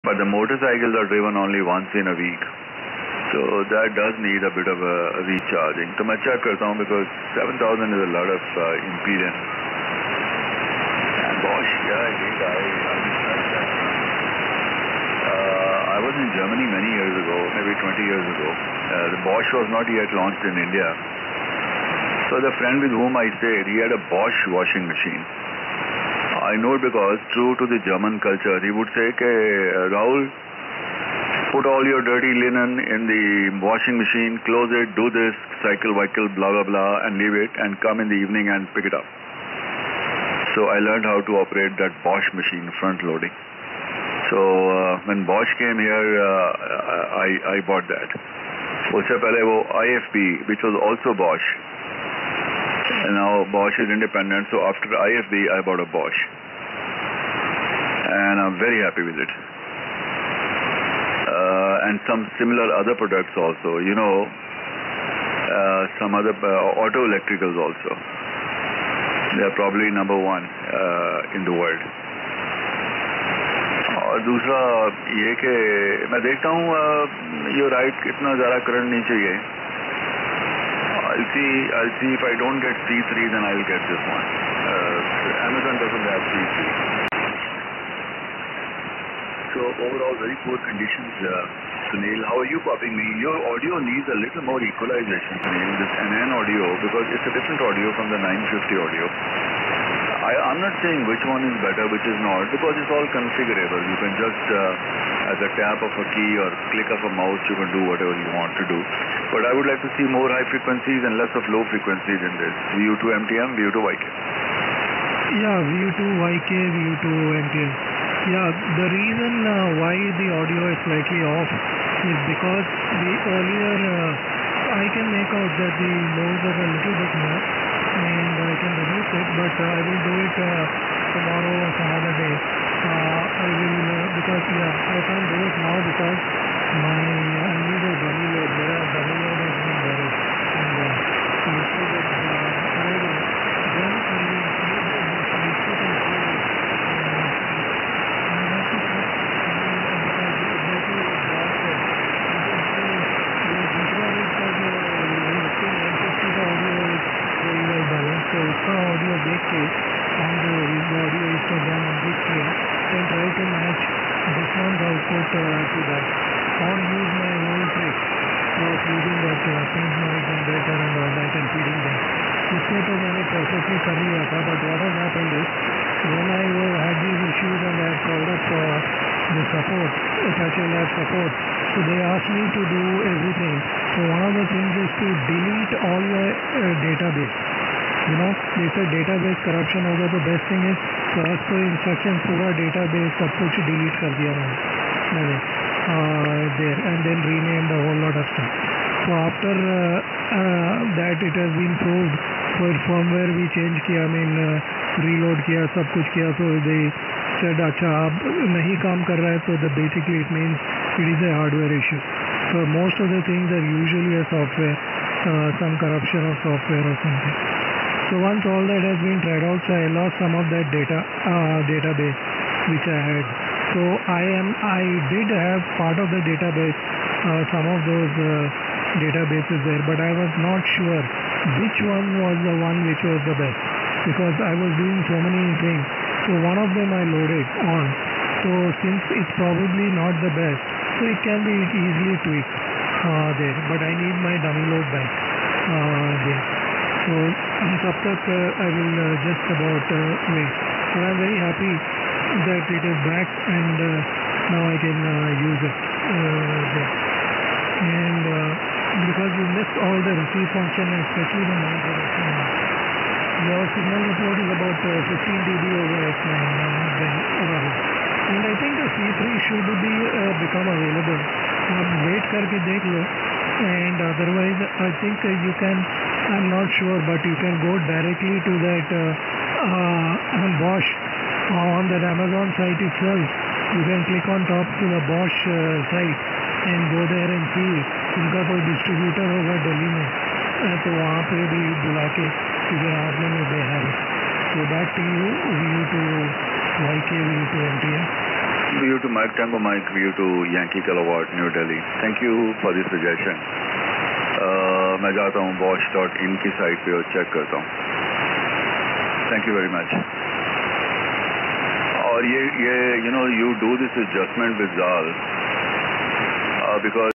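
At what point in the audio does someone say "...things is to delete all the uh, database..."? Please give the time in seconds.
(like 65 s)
184 s.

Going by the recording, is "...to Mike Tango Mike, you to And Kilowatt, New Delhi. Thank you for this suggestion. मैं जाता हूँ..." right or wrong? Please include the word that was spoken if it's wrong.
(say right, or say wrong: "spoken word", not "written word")
wrong: "Yankee", not "And".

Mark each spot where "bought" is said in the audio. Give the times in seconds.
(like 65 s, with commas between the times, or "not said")
47 s, 55 s.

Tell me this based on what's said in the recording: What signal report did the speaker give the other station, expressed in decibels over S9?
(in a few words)
15 dB over S9.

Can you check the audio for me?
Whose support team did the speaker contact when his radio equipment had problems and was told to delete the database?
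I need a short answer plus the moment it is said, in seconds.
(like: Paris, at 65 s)
Apache Lab, at 180 s.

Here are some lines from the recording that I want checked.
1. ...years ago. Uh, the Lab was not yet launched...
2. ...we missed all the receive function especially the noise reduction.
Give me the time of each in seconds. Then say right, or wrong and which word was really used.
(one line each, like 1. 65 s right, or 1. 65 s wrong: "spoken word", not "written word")
1. 18 s wrong: "Bosch", not "Lab"
2. 259 s right.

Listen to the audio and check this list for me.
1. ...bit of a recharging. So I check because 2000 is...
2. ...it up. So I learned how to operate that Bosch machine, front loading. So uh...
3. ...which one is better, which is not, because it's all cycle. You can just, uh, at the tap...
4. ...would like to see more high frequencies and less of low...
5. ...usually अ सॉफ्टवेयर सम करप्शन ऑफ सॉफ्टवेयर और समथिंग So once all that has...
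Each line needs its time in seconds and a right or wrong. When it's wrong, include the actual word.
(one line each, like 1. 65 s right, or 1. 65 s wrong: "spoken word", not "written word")
1. 4 s wrong: "7000", not "2000"
2. 38 s right
3. 101 s wrong: "configurable", not "cycle"
4. 109 s right
5. 213 s right.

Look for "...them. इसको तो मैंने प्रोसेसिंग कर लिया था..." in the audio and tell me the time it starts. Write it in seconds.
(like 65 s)
171 s.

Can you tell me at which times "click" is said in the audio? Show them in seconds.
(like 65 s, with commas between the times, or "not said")
106 s, 284 s.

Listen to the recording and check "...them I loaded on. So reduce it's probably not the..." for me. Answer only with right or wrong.
wrong.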